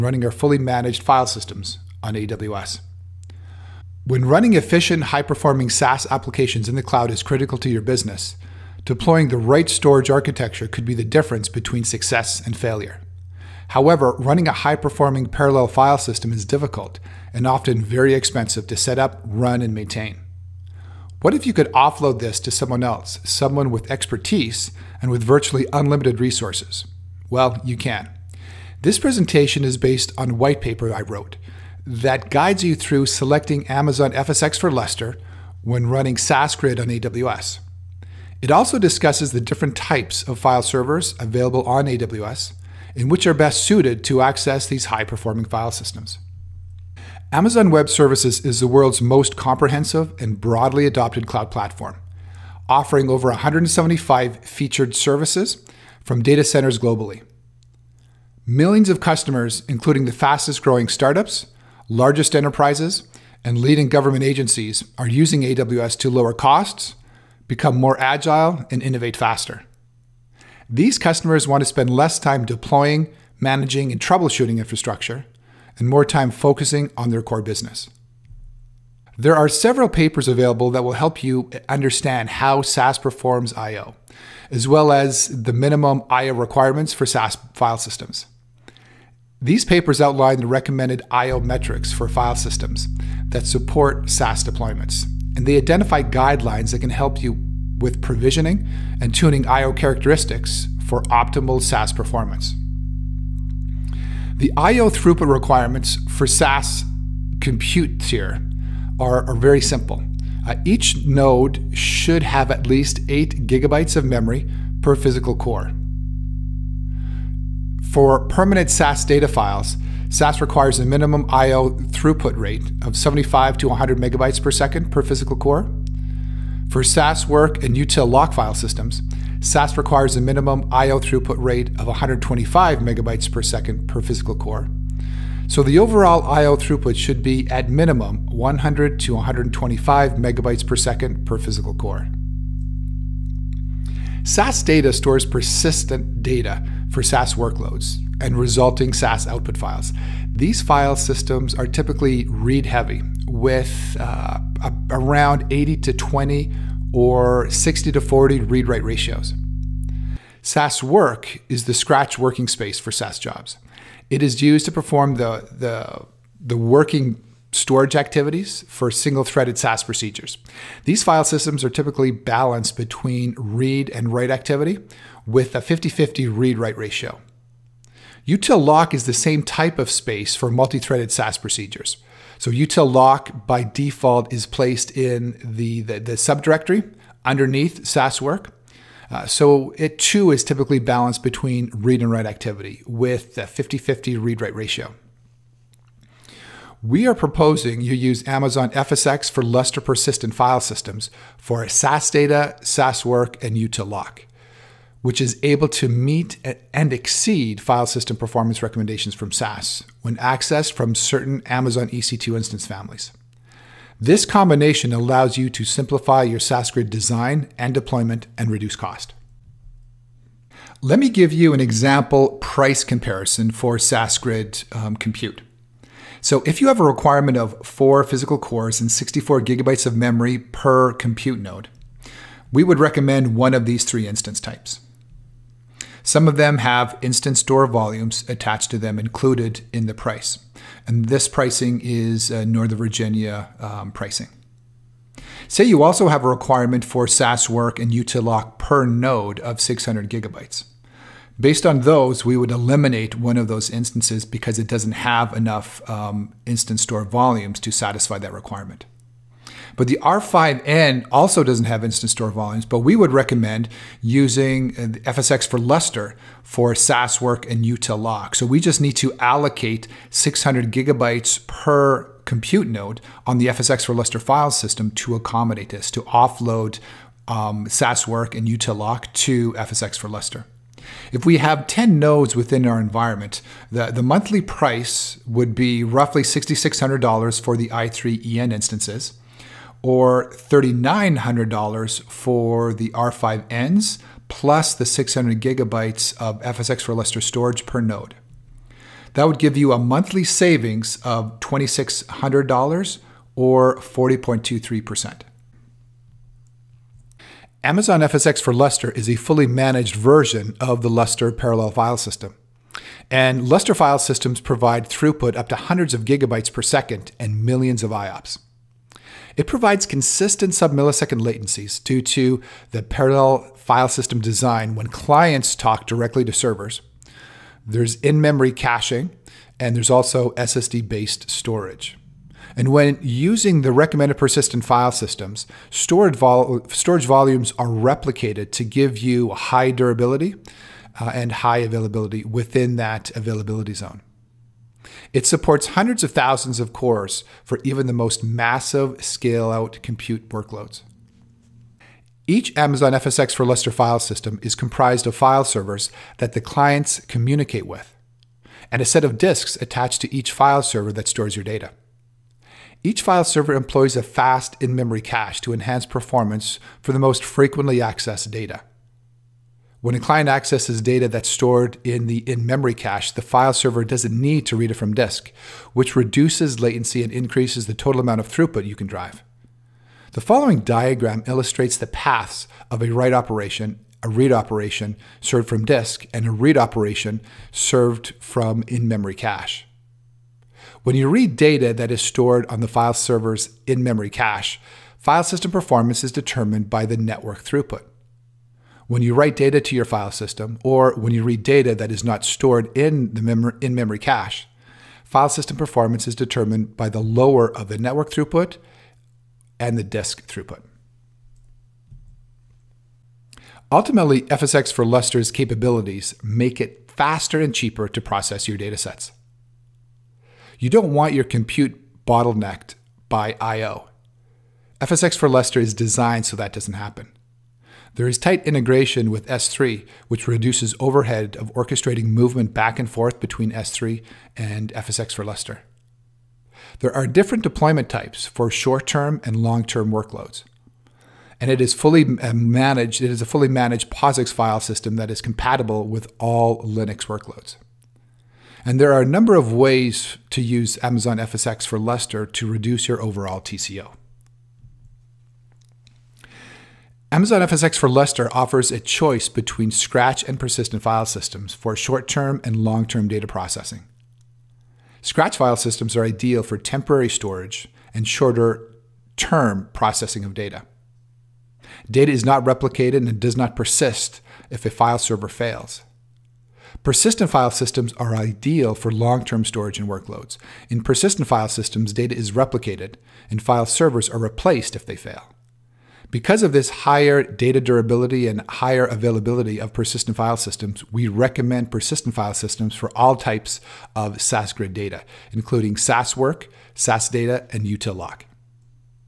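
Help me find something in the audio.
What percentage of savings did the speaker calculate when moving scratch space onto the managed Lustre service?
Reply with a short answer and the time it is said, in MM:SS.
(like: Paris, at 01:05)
40.23%, at 05:03.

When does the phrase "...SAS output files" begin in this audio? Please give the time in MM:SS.
02:28.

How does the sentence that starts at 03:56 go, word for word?
Some of them have instance store volumes attached to them included in the price.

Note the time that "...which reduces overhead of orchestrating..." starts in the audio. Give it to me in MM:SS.
07:10.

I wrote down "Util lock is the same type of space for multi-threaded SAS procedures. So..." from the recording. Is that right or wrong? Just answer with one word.
right.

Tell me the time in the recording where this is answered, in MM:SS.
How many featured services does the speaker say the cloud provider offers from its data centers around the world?
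00:53.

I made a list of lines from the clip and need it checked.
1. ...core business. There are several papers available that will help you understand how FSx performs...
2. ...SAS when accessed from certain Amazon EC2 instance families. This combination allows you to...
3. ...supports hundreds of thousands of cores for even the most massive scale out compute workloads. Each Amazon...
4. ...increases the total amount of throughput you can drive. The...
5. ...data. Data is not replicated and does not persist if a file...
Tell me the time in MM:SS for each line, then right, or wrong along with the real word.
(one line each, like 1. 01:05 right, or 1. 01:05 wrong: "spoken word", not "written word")
1. 01:17 wrong: "SAS", not "FSx"
2. 03:29 right
3. 05:45 right
4. 06:17 right
5. 07:50 right.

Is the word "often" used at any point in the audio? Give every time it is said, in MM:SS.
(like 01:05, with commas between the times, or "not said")
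00:17.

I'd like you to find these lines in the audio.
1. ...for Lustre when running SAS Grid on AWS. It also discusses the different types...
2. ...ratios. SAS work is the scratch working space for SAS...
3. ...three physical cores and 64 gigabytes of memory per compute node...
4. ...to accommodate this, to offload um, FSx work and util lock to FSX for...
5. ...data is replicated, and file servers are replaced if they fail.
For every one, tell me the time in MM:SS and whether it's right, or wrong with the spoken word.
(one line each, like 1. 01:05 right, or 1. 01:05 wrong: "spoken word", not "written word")
1. 00:34 right
2. 02:38 right
3. 03:47 wrong: "four", not "three"
4. 04:34 wrong: "SAS", not "FSx"
5. 08:01 right.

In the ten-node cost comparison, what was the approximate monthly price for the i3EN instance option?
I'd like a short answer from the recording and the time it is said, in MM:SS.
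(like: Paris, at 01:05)
$6,600, at 04:46.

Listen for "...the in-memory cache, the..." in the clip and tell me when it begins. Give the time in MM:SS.
06:12.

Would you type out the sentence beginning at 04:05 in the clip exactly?
Say you also have a requirement for SAS work and Utilock per node of 600 gigabytes.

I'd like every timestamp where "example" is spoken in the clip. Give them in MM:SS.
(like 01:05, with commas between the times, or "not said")
03:41.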